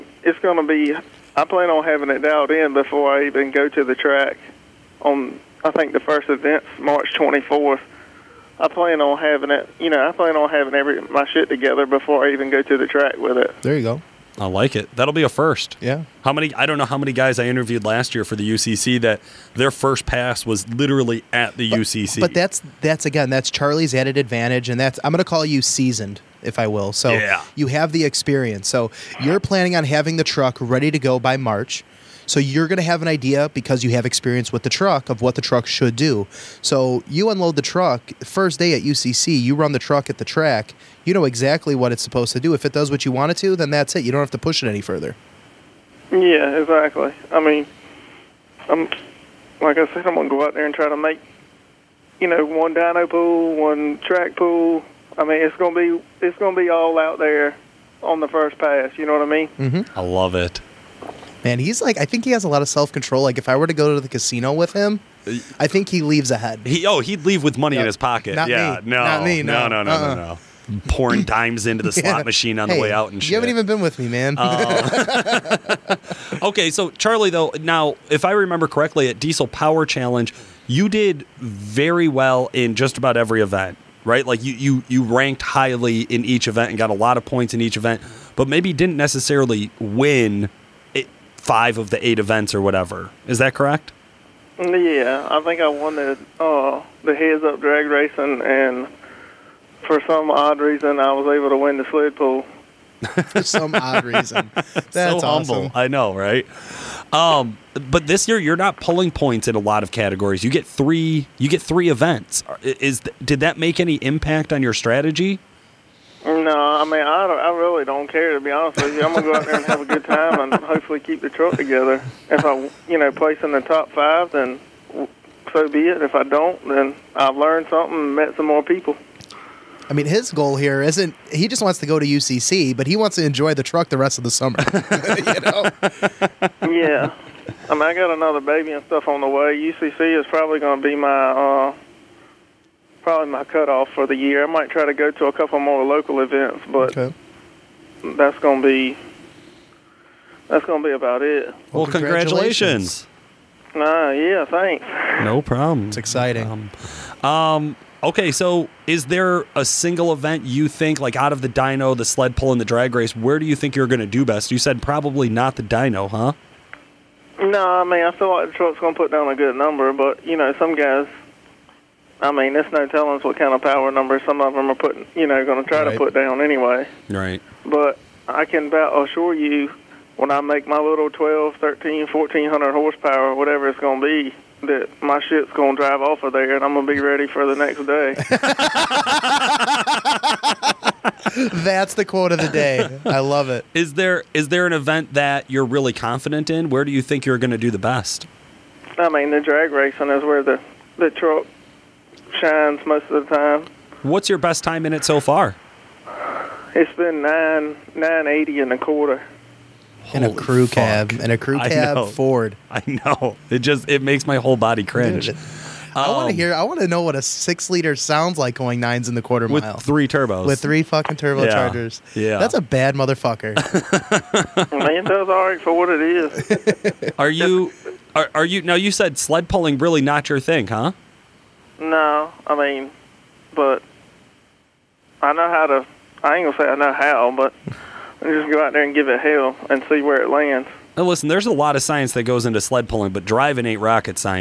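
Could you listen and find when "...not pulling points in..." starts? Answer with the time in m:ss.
1:48.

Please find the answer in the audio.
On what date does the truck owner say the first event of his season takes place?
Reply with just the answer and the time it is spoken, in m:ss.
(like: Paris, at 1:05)
March 24th, at 0:06.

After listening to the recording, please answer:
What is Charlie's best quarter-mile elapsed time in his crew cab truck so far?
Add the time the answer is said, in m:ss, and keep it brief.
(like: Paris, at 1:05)
9.80, at 3:27.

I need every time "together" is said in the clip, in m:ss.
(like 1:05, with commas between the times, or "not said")
0:11, 2:01.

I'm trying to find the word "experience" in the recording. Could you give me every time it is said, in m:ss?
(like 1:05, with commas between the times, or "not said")
0:28, 0:34.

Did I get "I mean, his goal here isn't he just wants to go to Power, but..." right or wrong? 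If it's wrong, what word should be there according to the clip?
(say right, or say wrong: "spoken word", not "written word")
wrong: "UCC", not "Power".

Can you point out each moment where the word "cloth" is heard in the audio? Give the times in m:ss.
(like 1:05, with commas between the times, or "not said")
not said.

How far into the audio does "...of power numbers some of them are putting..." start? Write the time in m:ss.
2:53.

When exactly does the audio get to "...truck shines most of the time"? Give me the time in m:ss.
3:21.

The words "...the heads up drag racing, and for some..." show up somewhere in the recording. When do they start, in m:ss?
1:37.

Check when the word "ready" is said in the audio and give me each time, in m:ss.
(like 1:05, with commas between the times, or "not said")
0:30, 3:06.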